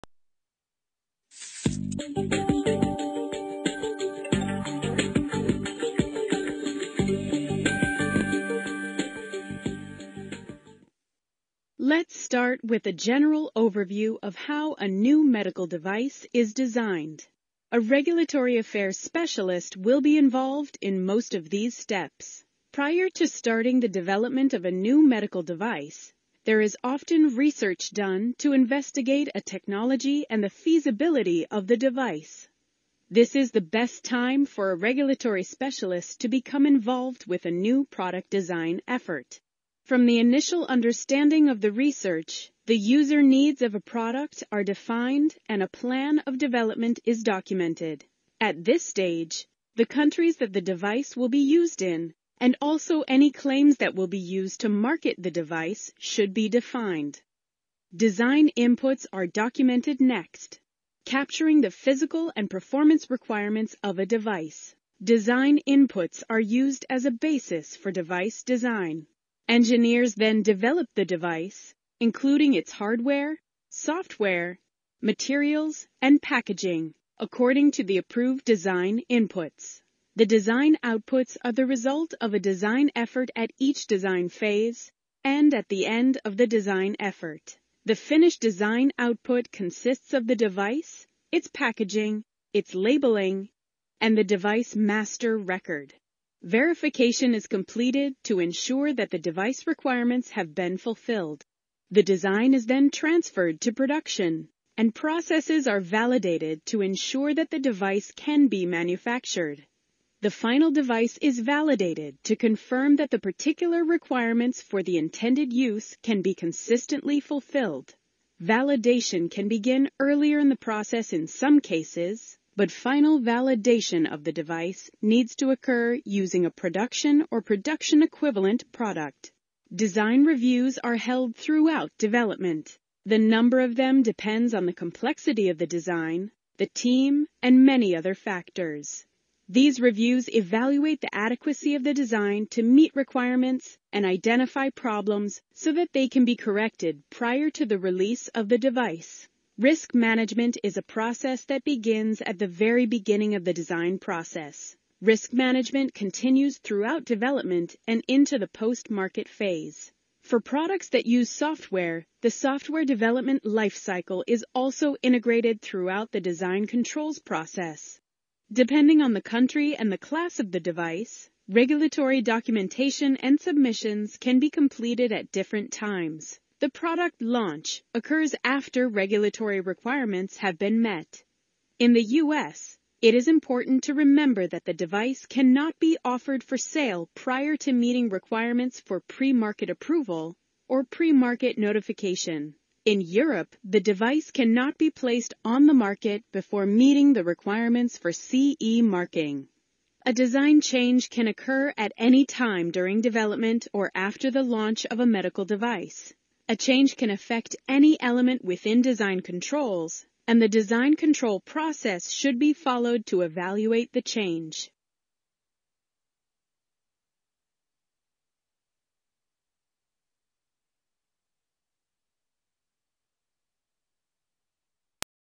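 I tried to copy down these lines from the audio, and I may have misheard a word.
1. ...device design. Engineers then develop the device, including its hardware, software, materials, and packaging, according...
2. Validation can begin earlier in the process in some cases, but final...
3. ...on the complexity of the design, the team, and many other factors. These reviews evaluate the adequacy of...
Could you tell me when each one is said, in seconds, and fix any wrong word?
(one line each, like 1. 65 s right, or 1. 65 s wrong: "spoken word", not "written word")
1. 67 s right
2. 118 s right
3. 134 s right.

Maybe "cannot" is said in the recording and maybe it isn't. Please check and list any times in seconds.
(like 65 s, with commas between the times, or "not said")
185 s, 194 s.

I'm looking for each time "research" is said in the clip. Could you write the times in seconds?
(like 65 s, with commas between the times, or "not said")
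27 s, 41 s.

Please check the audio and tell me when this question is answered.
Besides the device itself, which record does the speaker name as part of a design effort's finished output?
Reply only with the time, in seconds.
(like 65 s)
94 s.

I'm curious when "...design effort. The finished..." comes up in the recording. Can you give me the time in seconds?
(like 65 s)
86 s.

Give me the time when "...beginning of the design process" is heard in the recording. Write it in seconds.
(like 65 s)
152 s.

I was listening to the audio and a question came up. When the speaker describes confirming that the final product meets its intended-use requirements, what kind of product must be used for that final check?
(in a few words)
production or production equivalent.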